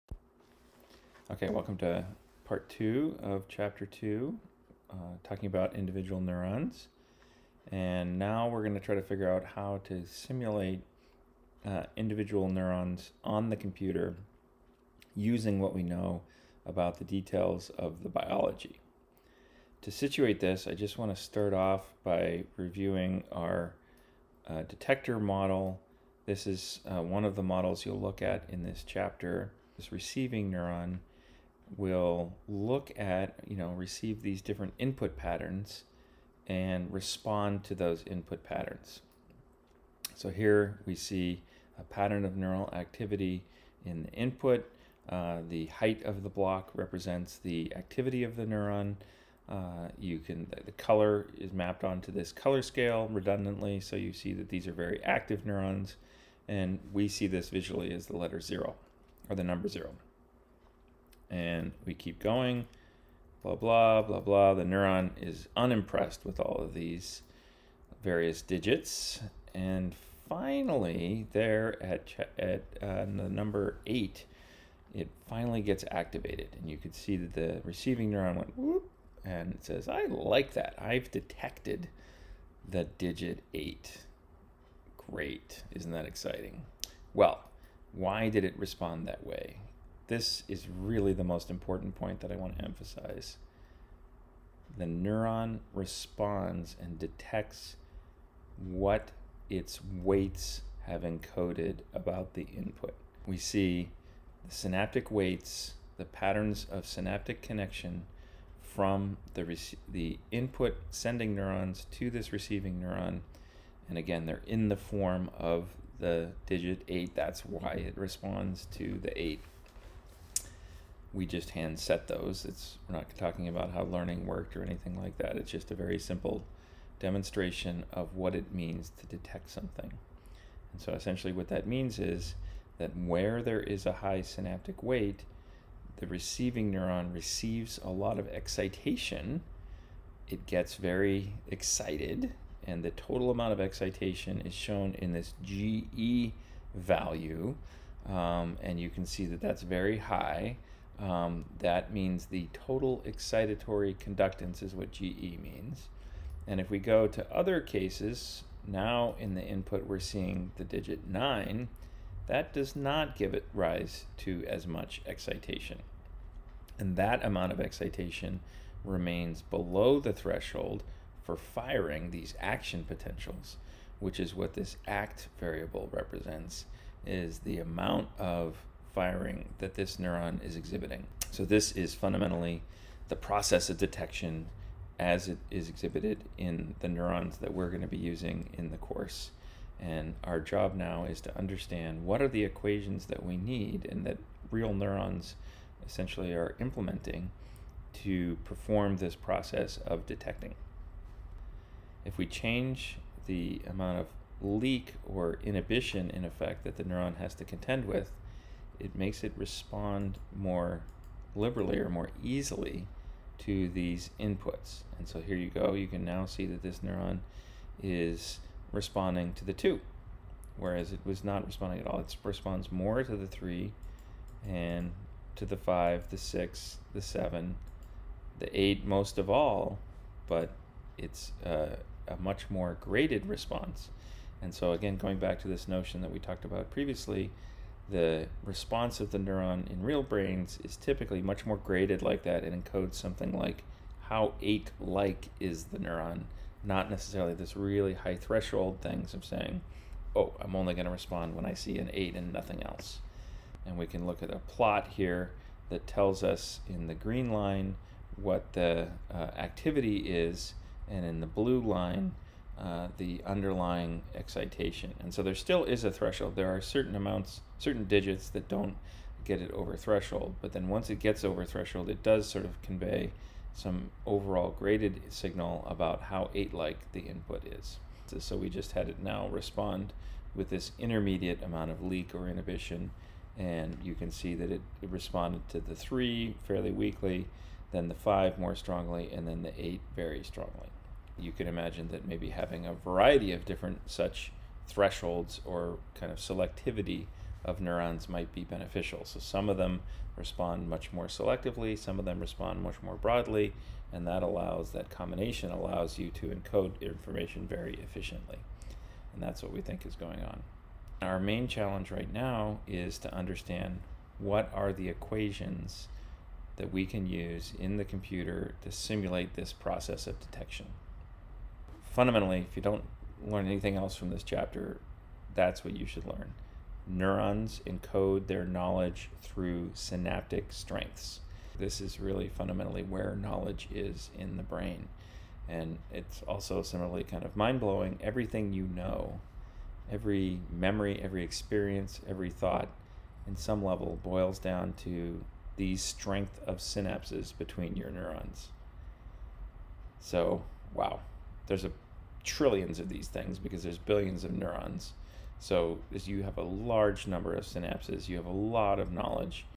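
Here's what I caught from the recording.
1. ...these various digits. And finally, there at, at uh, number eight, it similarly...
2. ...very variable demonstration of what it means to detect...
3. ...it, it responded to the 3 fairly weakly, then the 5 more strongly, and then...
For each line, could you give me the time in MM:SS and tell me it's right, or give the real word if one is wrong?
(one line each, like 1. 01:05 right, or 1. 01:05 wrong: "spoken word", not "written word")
1. 01:06 wrong: "finally", not "similarly"
2. 02:05 wrong: "simple", not "variable"
3. 04:44 right.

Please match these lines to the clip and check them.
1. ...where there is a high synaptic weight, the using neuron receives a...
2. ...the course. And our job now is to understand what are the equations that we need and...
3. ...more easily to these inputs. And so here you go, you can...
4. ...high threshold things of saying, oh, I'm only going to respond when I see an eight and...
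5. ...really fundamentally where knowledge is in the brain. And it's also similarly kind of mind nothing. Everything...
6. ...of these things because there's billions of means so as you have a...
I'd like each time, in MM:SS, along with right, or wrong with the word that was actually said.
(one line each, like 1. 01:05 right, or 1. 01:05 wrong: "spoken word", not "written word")
1. 02:12 wrong: "receiving", not "using"
2. 03:08 right
3. 03:31 right
4. 04:07 right
5. 05:31 wrong: "blowing", not "nothing"
6. 05:52 wrong: "neurons", not "means".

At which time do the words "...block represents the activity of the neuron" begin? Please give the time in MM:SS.
00:46.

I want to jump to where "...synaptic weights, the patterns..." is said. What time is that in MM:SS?
01:44.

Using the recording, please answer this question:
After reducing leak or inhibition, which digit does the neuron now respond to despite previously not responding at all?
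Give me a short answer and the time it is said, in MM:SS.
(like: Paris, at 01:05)
2, at 03:39.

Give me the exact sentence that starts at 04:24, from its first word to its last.
And so there still is a threshold.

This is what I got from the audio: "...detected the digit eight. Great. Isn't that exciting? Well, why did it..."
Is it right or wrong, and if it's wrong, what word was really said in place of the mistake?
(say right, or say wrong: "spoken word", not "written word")
right.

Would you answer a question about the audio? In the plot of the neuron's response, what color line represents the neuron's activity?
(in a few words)
green.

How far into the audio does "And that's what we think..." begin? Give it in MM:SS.
05:09.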